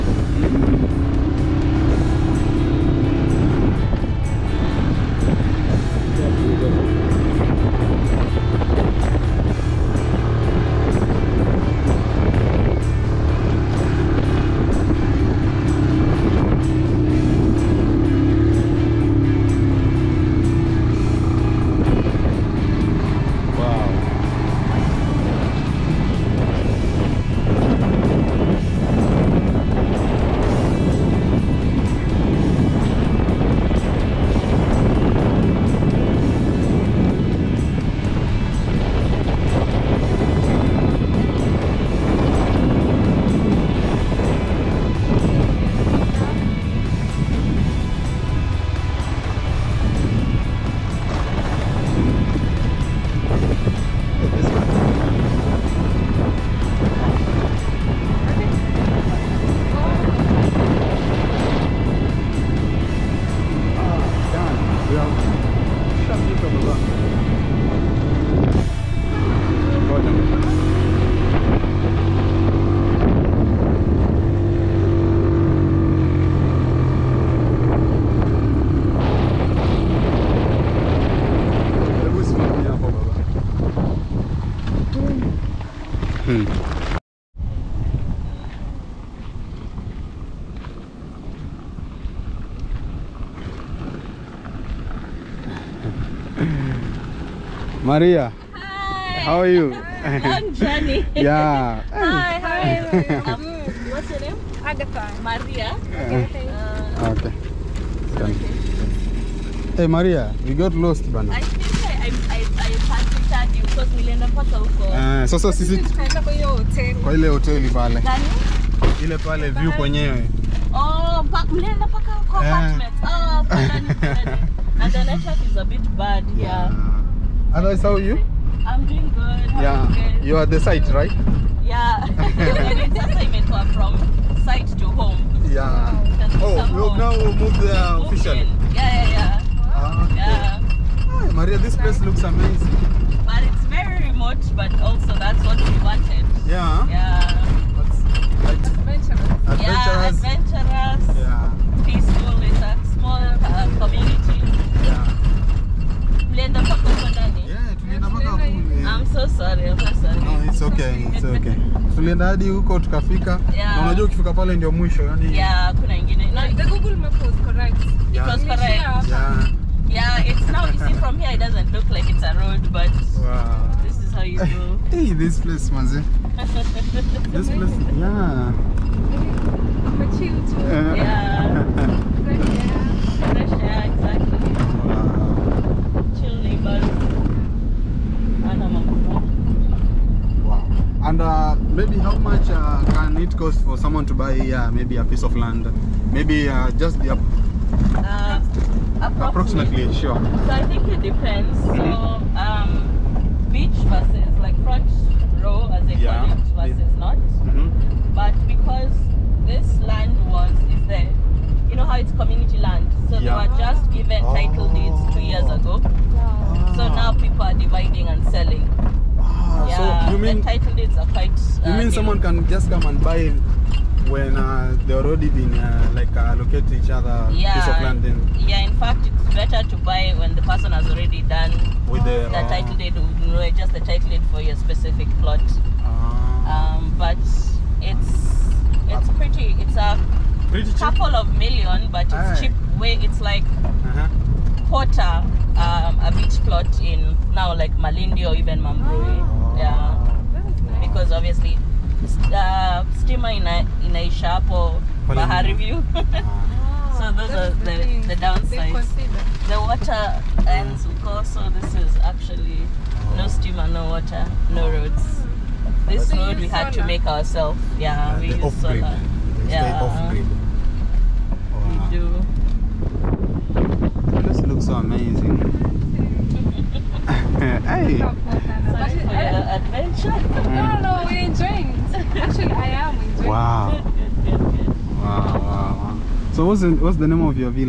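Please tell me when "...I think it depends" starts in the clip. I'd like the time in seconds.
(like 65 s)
200 s.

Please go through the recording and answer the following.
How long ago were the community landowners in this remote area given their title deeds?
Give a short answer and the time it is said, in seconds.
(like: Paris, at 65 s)
2 years, at 215 s.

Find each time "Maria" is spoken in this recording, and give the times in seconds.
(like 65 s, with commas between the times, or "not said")
97 s, 105 s, 109 s, 141 s.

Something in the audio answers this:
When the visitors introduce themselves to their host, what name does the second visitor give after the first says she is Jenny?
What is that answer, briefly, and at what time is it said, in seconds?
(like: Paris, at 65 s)
Agatha, at 104 s.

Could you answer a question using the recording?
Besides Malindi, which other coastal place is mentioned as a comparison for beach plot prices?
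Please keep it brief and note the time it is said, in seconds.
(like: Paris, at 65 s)
Mambrui, at 248 s.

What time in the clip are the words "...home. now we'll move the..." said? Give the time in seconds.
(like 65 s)
136 s.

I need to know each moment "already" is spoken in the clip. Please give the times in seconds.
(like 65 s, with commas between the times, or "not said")
224 s, 230 s.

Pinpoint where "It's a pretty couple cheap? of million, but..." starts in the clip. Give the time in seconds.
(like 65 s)
239 s.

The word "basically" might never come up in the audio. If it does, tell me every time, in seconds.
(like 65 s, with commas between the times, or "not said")
not said.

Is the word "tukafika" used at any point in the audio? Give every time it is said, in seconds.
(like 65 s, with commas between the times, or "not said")
162 s.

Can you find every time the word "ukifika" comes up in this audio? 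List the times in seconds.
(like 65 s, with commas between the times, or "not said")
164 s.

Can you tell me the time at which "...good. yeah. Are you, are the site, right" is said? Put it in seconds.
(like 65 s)
129 s.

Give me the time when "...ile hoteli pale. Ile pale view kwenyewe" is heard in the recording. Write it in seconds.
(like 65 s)
117 s.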